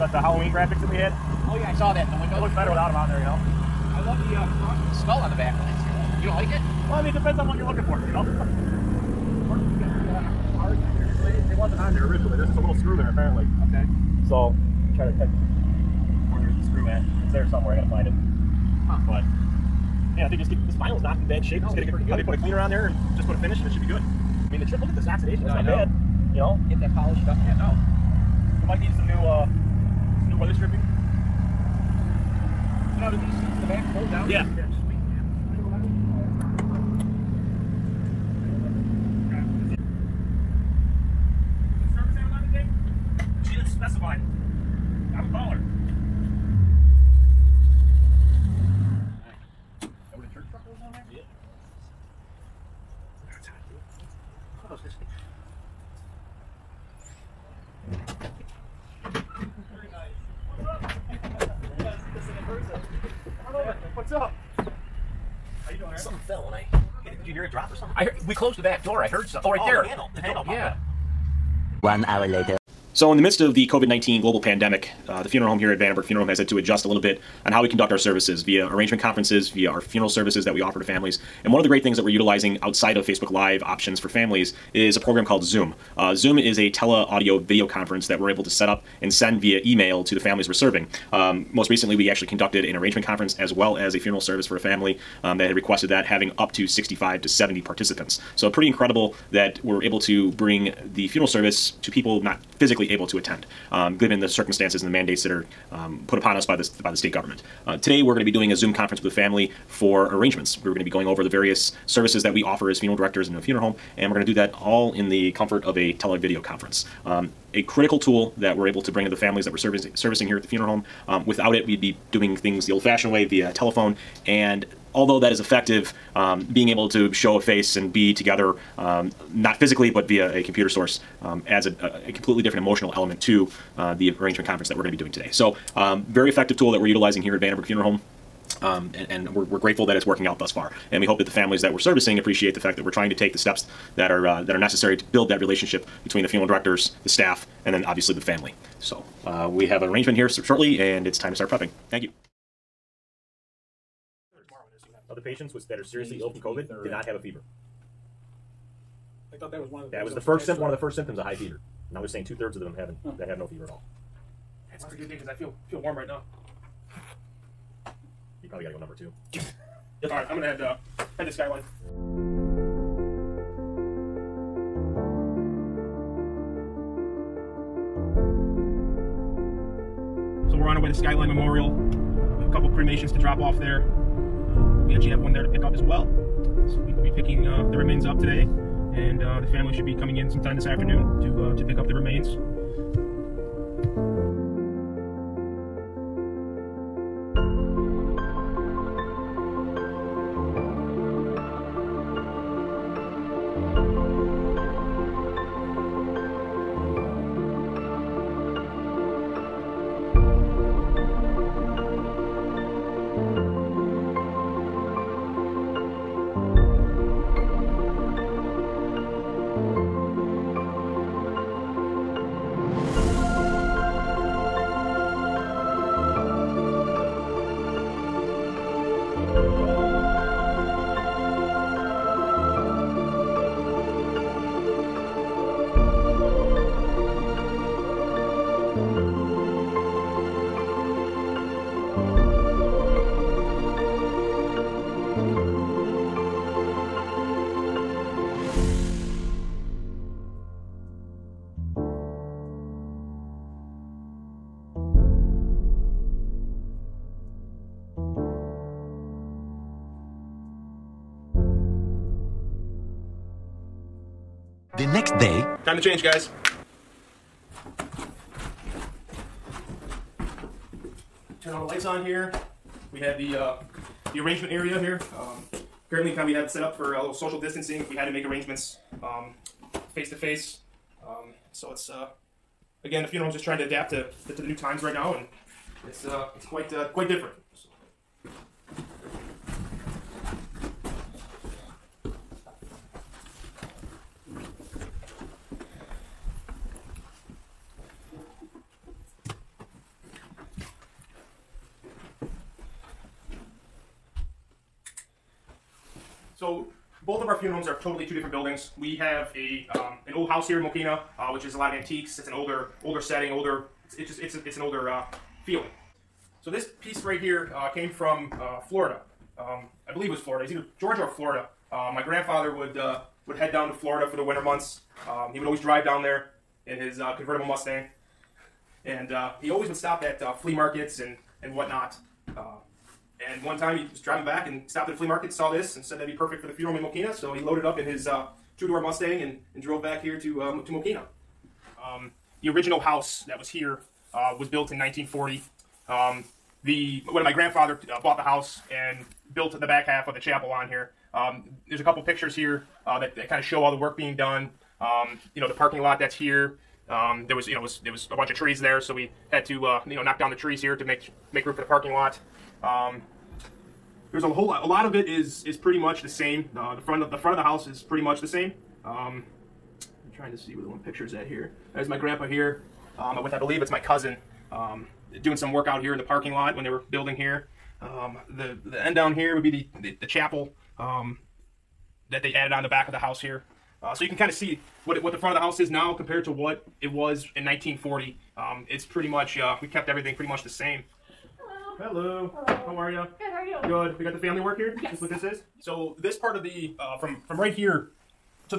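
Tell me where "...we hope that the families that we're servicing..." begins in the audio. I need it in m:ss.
2:21.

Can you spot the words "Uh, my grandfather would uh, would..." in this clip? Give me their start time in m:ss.
5:21.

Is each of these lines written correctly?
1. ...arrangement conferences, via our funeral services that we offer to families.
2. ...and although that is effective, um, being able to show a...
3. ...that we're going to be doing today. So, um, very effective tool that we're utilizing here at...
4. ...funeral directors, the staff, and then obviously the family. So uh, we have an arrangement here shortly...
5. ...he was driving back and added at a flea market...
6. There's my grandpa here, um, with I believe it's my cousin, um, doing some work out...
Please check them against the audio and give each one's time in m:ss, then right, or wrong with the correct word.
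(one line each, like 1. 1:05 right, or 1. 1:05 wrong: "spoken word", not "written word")
1. 1:18 right
2. 2:04 right
3. 2:14 right
4. 2:26 right
5. 5:33 wrong: "stopped", not "added"
6. 6:11 right.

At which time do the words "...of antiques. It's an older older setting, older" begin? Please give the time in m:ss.
5:11.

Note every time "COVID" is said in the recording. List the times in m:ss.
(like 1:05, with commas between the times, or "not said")
1:13, 2:36.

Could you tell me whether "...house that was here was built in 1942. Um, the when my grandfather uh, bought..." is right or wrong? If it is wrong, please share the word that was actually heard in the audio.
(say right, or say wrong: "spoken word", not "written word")
wrong: "1940", not "1942".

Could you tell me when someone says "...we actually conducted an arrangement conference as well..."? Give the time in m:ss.
1:31.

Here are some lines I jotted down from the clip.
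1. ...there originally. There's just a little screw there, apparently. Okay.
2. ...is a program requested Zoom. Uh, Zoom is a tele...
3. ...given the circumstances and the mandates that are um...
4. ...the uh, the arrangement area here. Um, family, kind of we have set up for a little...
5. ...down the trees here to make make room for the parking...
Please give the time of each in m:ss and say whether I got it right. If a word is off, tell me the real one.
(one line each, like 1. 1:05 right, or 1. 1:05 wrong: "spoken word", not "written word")
1. 0:11 right
2. 1:24 wrong: "called", not "requested"
3. 1:43 right
4. 4:33 wrong: "currently", not "family"
5. 6:00 right.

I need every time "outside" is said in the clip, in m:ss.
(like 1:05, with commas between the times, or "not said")
1:22.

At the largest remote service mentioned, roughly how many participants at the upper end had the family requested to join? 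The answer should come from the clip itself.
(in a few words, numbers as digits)
70.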